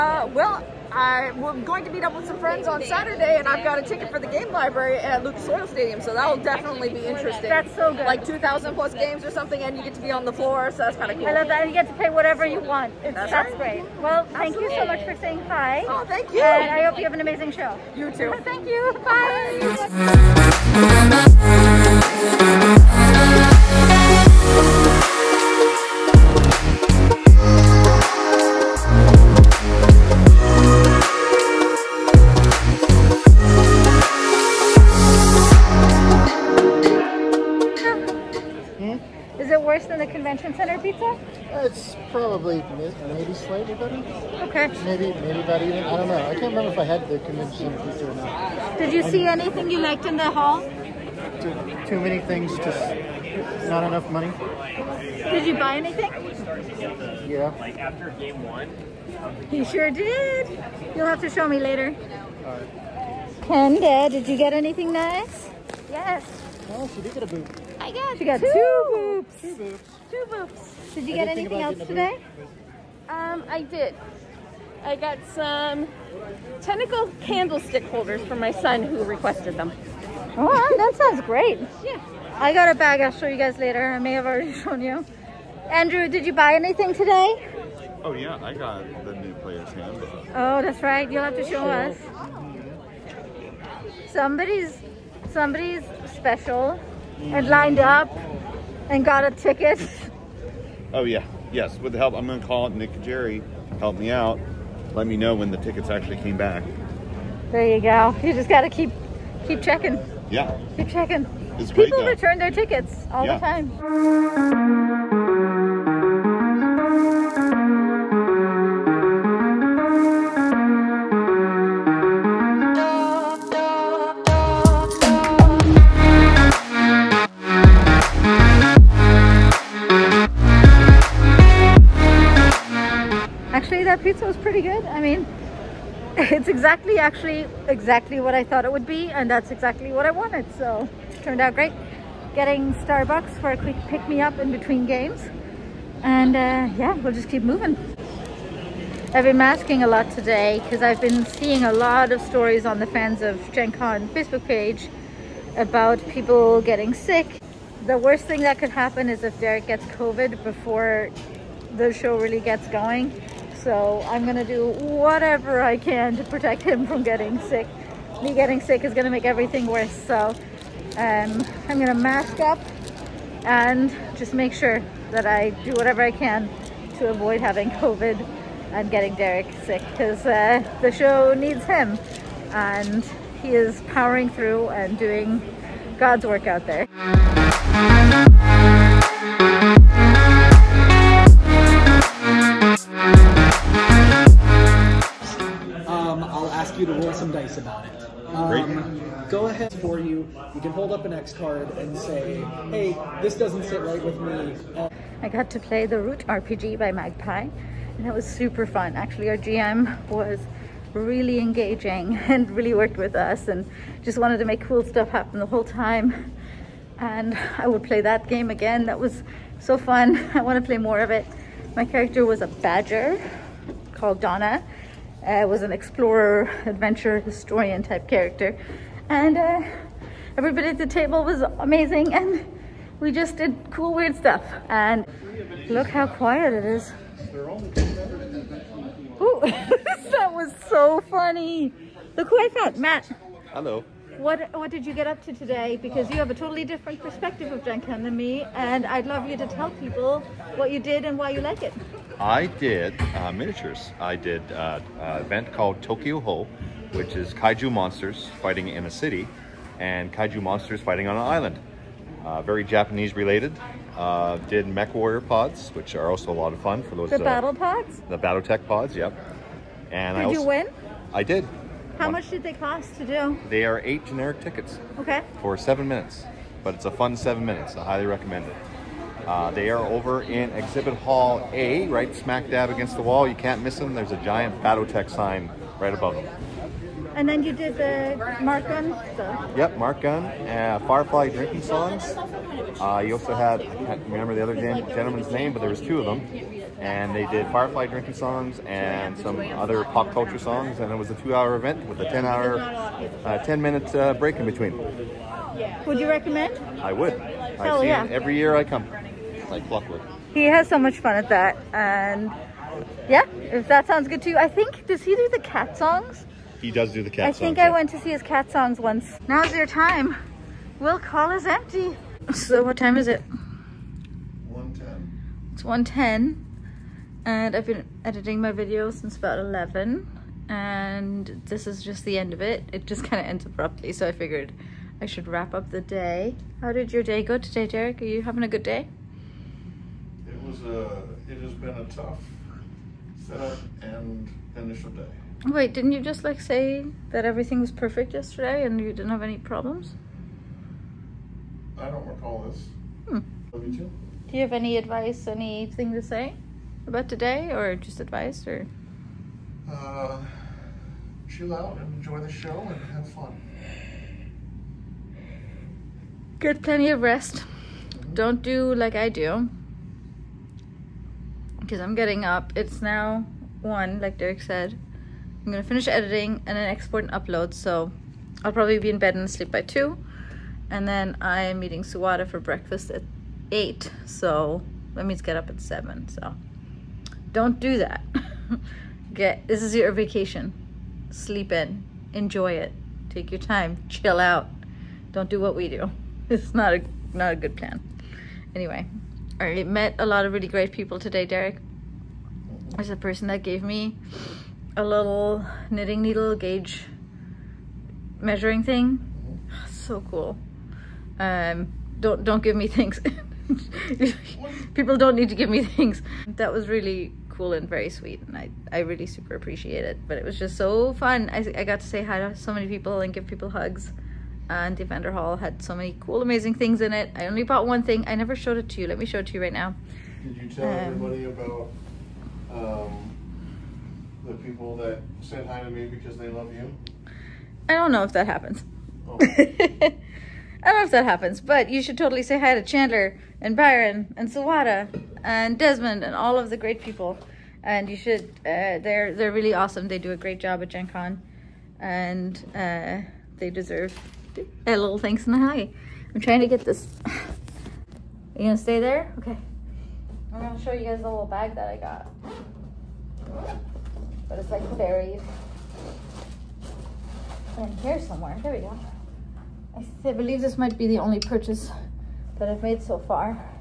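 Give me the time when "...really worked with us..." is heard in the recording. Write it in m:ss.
3:32.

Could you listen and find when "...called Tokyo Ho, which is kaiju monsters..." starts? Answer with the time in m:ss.
4:15.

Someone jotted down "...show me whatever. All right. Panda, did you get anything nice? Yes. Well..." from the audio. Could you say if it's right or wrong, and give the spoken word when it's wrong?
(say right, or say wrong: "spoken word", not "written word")
wrong: "later", not "whatever".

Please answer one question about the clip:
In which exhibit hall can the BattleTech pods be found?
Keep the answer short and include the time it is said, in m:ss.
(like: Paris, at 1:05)
Exhibit Hall A, at 4:40.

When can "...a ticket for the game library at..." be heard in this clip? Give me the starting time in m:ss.
0:03.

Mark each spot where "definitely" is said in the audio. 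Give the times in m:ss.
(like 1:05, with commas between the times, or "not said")
0:06.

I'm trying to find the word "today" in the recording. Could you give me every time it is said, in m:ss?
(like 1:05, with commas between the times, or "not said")
1:11, 1:26, 2:30, 4:05, 5:37, 5:57, 6:40.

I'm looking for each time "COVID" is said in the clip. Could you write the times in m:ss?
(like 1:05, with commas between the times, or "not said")
2:39, 2:57.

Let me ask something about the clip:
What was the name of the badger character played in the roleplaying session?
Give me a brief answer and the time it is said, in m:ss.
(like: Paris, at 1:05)
Donna, at 3:44.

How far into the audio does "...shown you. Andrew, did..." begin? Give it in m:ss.
1:24.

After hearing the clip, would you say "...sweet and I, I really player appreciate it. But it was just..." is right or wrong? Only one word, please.
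wrong.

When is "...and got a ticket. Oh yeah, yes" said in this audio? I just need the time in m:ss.
1:38.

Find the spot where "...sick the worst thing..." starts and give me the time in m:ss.
2:36.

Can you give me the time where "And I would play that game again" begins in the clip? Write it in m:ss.
3:36.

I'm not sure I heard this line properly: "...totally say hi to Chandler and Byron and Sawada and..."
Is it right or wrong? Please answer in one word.
right.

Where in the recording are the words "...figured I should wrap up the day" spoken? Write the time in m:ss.
5:34.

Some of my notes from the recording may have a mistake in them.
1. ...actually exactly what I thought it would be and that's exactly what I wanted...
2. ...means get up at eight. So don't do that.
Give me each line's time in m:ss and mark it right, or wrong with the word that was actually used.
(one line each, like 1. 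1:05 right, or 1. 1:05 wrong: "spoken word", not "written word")
1. 2:16 right
2. 6:25 wrong: "seven", not "eight".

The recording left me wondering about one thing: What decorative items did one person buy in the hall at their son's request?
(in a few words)
tentacle candlestick holders.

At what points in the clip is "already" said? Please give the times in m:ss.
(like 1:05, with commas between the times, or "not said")
1:24.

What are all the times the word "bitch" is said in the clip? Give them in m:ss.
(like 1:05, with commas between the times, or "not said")
not said.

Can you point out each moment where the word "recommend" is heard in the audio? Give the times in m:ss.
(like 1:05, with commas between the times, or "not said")
4:38, 5:06.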